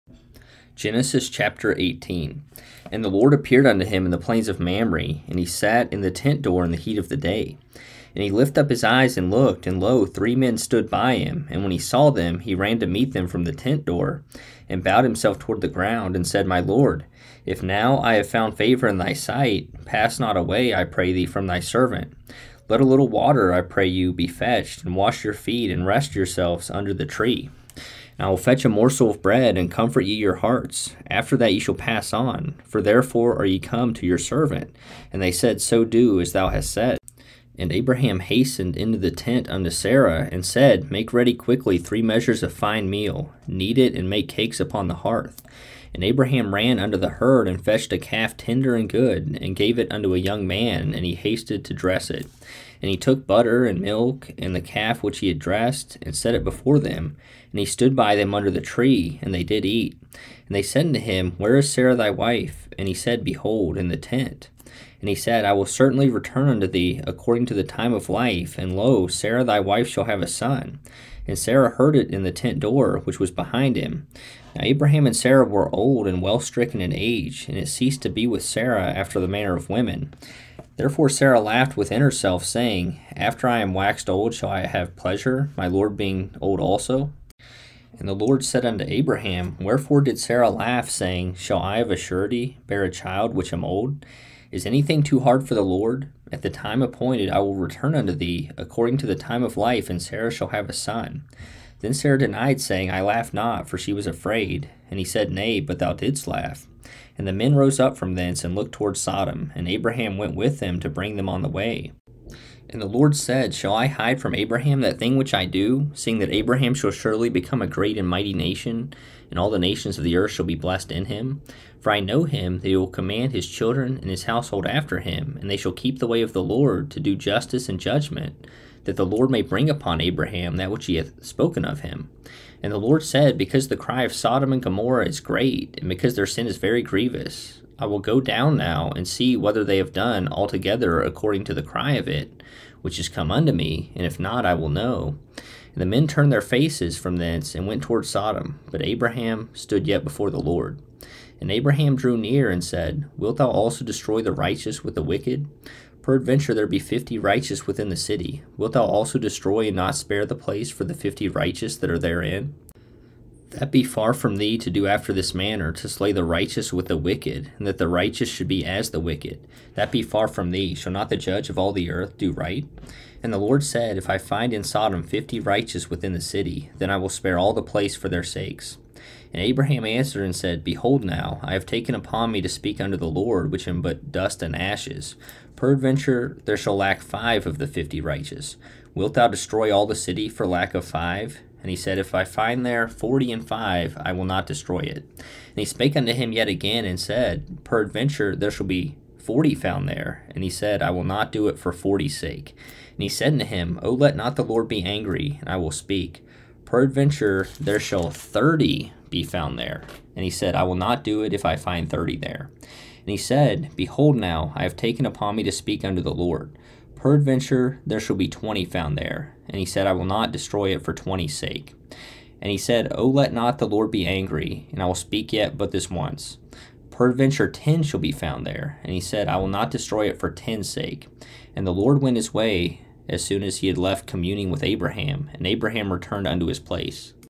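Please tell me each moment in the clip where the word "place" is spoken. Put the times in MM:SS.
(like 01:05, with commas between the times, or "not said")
02:40, 02:57, 03:56.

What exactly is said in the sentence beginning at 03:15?
And he spake unto him yet again and said, Peradventure there shall be forty found there.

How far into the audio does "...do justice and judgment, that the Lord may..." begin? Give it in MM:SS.
02:07.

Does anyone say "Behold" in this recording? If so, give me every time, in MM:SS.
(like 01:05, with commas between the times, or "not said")
01:03, 03:00, 03:33.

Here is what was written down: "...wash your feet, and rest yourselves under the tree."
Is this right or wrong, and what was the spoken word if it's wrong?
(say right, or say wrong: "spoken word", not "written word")
right.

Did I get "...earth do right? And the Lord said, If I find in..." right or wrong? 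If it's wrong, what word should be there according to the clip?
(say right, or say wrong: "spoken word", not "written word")
right.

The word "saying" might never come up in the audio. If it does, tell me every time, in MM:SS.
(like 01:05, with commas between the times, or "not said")
01:22, 01:30, 01:42.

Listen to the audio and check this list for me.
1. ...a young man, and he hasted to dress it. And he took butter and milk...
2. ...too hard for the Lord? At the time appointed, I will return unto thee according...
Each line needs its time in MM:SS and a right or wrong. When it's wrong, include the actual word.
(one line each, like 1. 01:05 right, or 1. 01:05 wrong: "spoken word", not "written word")
1. 00:50 right
2. 01:35 right.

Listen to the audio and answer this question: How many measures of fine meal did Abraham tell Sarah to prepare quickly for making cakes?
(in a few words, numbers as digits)
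3.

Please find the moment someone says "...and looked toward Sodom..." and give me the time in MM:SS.
01:48.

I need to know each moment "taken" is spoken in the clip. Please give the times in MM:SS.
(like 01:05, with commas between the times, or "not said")
03:01, 03:34.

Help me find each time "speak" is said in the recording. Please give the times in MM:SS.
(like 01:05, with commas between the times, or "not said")
03:02, 03:25, 03:35, 03:44.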